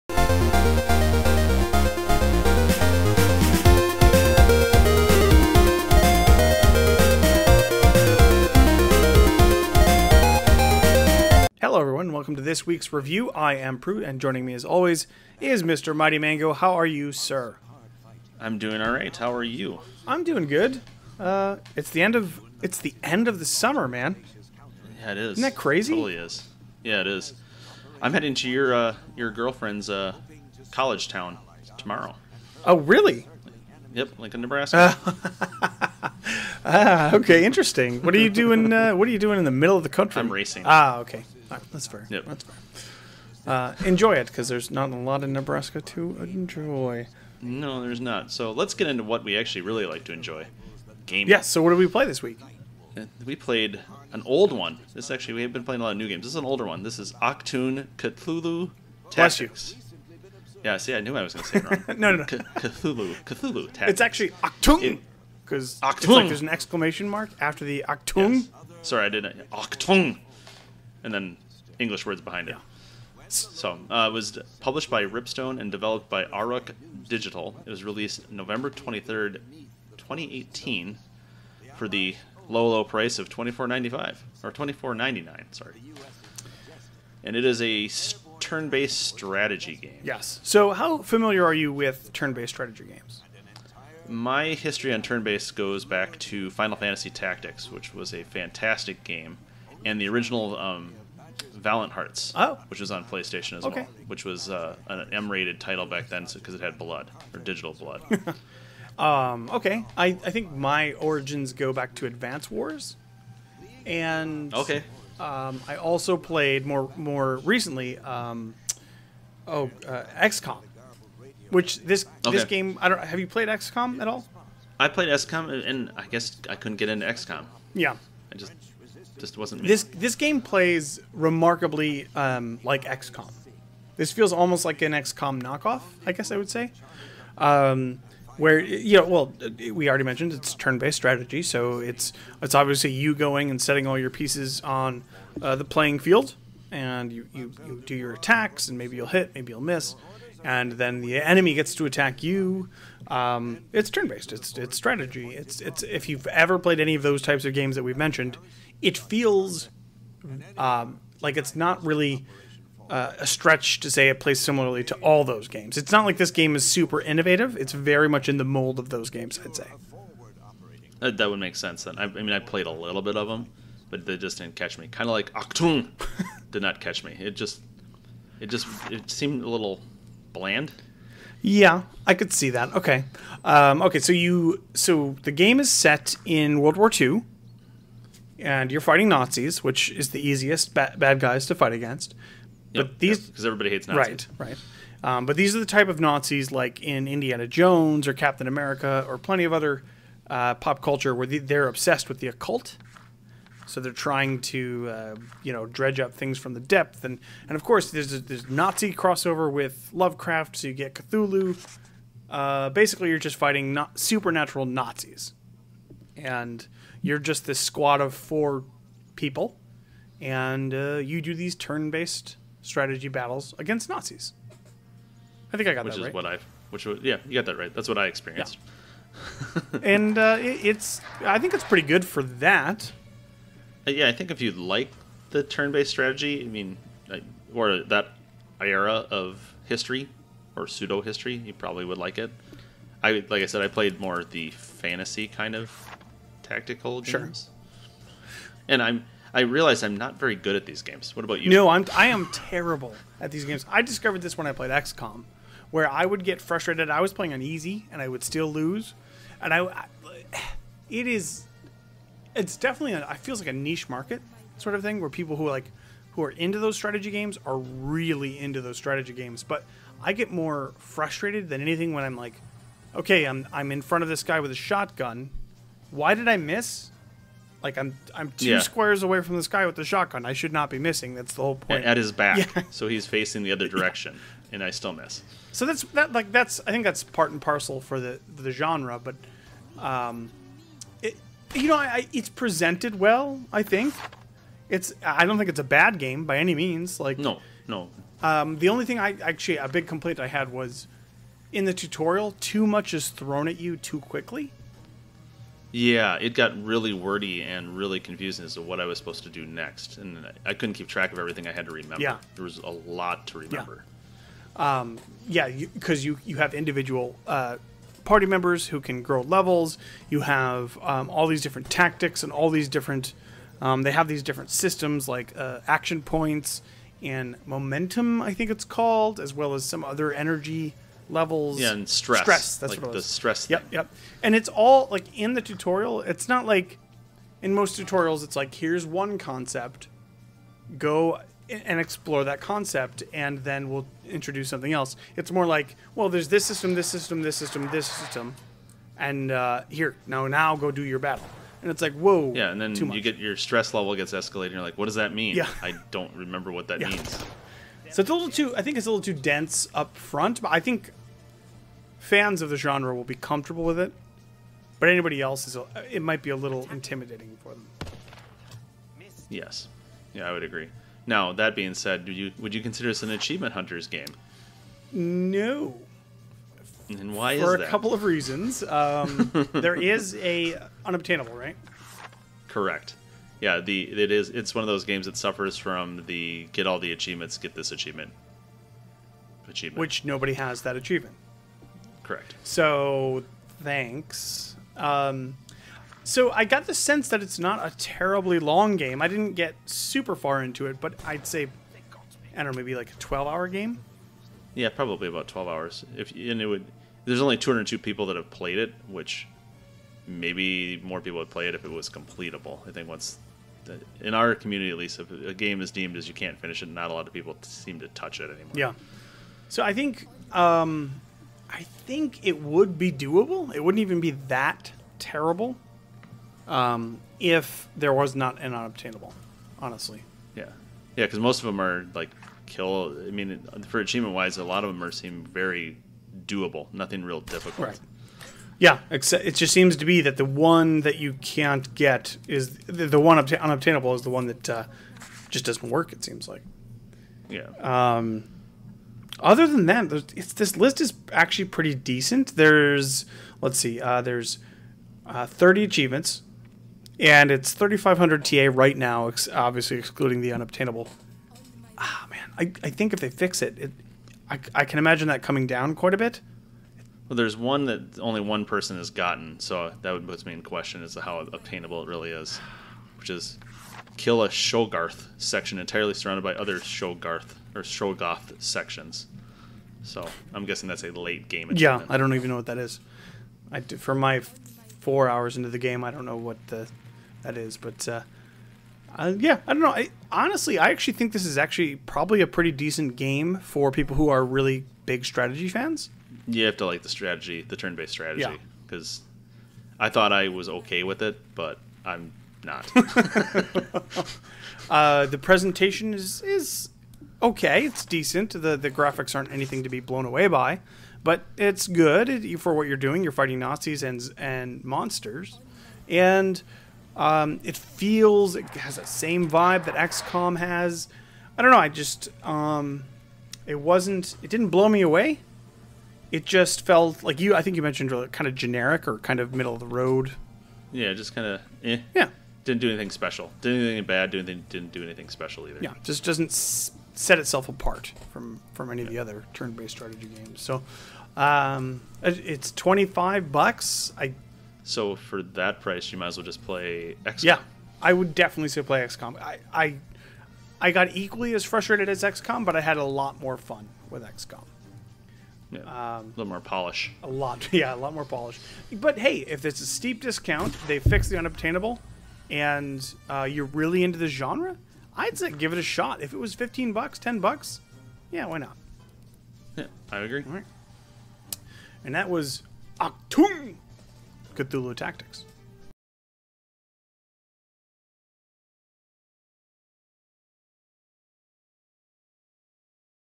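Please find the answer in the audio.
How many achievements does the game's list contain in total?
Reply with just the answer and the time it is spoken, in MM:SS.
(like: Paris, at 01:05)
30, at 07:35.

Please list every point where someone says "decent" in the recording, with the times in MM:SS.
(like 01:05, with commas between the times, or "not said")
07:31, 08:12, 08:27.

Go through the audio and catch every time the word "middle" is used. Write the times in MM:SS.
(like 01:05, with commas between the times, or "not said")
00:39, 08:49.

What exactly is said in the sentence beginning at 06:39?
I didn't get super far into it, but I'd say I don't know, maybe like a 12-hour game.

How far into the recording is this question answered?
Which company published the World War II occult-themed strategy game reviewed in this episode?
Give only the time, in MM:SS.
01:15.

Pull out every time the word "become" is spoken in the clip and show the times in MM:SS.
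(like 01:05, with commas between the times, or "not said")
not said.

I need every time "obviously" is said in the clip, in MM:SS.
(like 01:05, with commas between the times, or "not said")
02:22, 07:39.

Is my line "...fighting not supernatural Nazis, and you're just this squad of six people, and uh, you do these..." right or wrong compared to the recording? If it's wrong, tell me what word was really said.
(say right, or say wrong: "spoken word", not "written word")
wrong: "four", not "six".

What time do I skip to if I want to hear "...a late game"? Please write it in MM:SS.
08:00.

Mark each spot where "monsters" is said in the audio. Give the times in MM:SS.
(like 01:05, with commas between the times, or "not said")
08:34.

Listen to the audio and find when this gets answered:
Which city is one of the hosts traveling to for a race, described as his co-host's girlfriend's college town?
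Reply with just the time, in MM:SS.
00:34.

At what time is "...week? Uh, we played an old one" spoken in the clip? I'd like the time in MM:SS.
00:52.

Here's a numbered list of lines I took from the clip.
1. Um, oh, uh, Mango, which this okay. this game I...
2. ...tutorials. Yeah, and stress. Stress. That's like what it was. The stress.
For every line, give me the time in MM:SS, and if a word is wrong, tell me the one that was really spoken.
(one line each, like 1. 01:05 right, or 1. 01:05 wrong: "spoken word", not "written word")
1. 01:57 wrong: "XCOM", not "Mango"
2. 05:31 wrong: "levels", not "tutorials".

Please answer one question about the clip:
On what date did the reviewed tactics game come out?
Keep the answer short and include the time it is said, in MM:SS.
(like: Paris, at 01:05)
November 23rd, 2018, at 01:18.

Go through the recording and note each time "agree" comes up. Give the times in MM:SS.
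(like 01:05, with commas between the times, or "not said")
06:10, 09:29.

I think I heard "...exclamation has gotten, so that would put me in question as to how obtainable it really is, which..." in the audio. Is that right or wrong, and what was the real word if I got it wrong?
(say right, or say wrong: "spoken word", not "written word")
wrong: "person", not "exclamation".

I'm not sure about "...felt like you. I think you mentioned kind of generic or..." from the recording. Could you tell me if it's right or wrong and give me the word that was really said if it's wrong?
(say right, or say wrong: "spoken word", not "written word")
right.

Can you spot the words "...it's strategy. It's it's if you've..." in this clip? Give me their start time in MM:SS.
02:34.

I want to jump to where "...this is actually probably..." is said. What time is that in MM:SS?
08:11.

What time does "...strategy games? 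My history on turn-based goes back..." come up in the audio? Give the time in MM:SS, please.
01:32.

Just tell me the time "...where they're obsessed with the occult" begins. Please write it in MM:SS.
03:21.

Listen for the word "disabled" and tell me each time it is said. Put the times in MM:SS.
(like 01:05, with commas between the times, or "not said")
not said.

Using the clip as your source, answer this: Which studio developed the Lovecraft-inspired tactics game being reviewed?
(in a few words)
Auroch Digital.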